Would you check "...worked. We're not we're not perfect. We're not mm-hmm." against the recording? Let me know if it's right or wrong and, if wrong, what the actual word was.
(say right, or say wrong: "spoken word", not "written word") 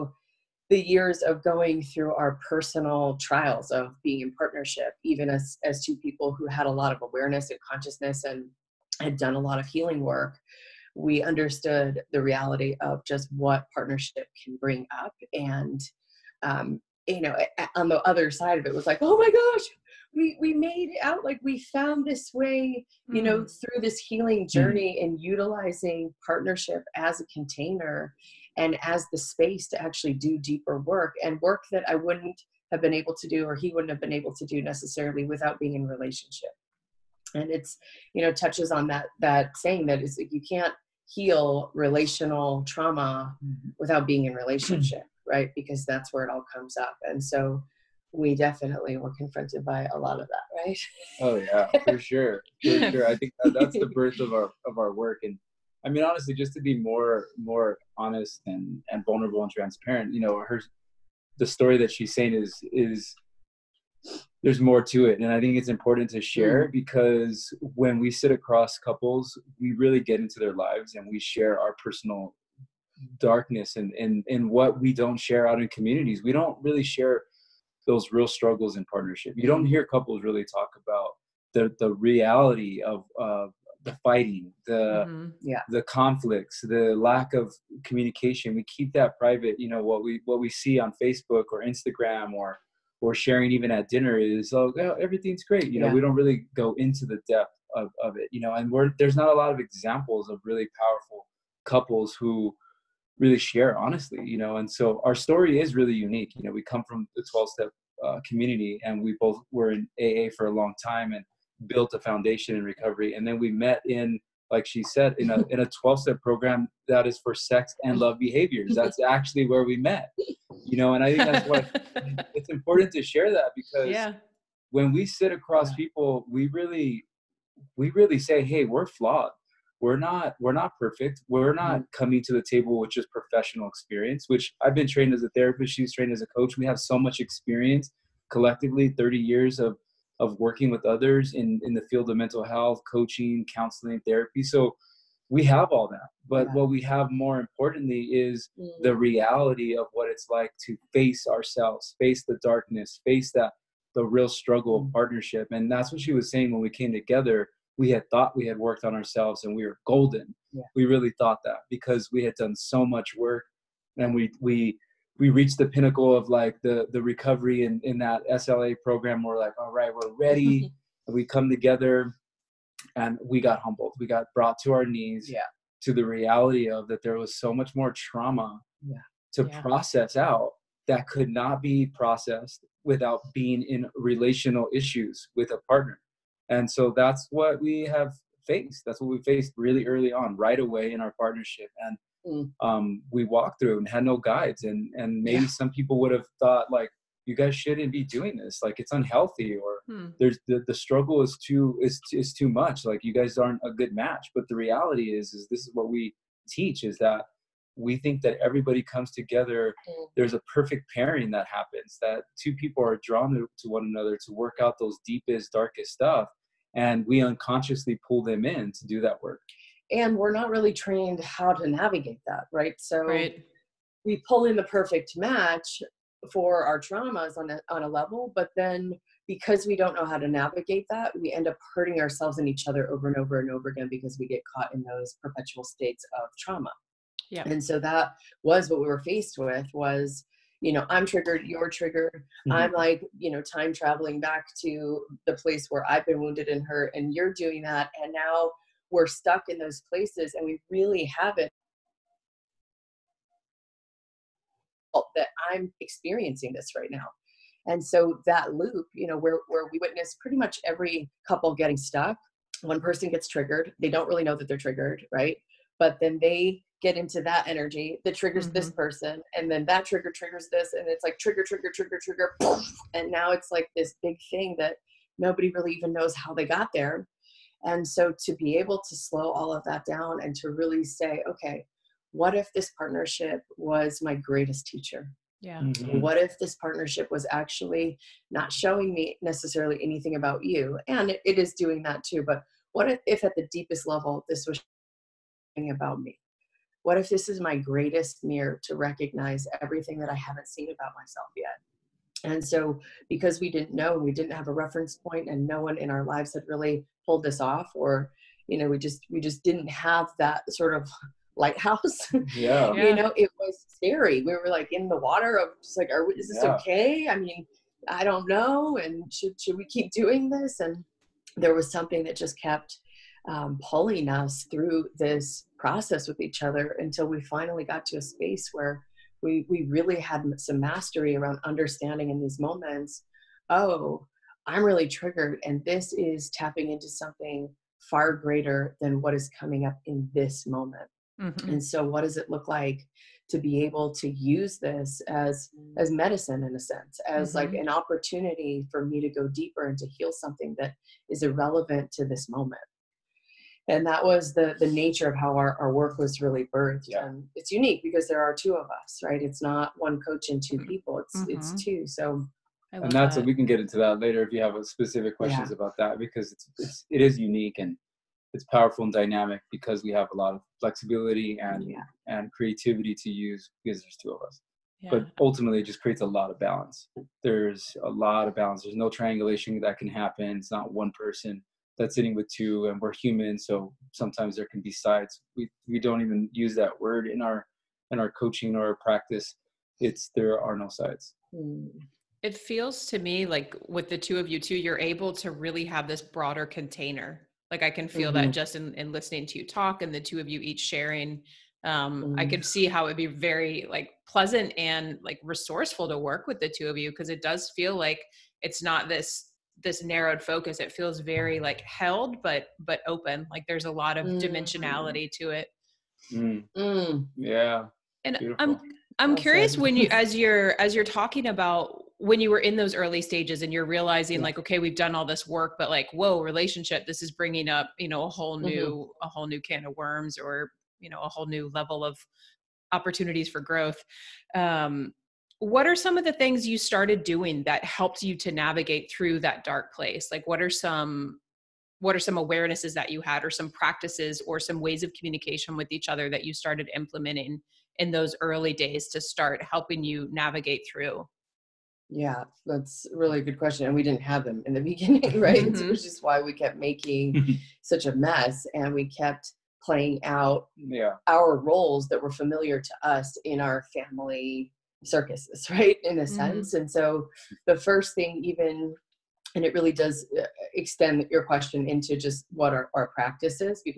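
wrong: "flawed", not "worked".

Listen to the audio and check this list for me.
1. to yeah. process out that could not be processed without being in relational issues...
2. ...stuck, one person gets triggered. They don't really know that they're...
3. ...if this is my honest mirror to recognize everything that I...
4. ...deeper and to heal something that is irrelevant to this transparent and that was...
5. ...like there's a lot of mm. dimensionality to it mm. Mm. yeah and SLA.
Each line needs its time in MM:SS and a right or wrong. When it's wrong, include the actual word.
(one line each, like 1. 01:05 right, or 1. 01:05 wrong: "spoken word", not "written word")
1. 02:59 right
2. 04:21 right
3. 04:56 wrong: "greatest", not "honest"
4. 05:49 wrong: "moment", not "transparent"
5. 06:53 wrong: "Beautiful", not "SLA".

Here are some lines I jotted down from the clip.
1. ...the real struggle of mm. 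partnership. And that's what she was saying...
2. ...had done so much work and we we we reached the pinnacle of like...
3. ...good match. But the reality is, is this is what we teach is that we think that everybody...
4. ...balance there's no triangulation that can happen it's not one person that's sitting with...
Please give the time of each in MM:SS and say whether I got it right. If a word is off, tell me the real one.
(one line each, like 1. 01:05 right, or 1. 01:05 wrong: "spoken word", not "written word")
1. 02:33 right
2. 02:42 right
3. 03:23 right
4. 06:18 right.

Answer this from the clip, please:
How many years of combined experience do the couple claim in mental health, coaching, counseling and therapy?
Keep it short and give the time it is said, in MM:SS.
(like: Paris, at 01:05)
30, at 02:18.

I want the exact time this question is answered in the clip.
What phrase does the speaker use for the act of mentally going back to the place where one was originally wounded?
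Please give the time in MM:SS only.
04:03.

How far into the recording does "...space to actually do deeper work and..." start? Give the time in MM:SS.
00:29.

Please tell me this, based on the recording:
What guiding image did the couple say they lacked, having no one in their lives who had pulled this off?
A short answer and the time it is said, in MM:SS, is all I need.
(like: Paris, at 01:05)
Lighthouse, at 05:11.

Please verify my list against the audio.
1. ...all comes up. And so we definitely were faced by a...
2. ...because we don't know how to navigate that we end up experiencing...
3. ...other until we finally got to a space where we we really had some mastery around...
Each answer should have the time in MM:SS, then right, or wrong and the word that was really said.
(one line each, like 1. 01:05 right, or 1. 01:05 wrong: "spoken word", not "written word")
1. 00:46 wrong: "confronted", not "faced"
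2. 03:49 wrong: "hurting", not "experiencing"
3. 05:26 right.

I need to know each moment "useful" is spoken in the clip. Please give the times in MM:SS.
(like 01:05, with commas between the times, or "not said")
not said.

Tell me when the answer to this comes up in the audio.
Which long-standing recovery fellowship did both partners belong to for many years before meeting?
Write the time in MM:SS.
01:50.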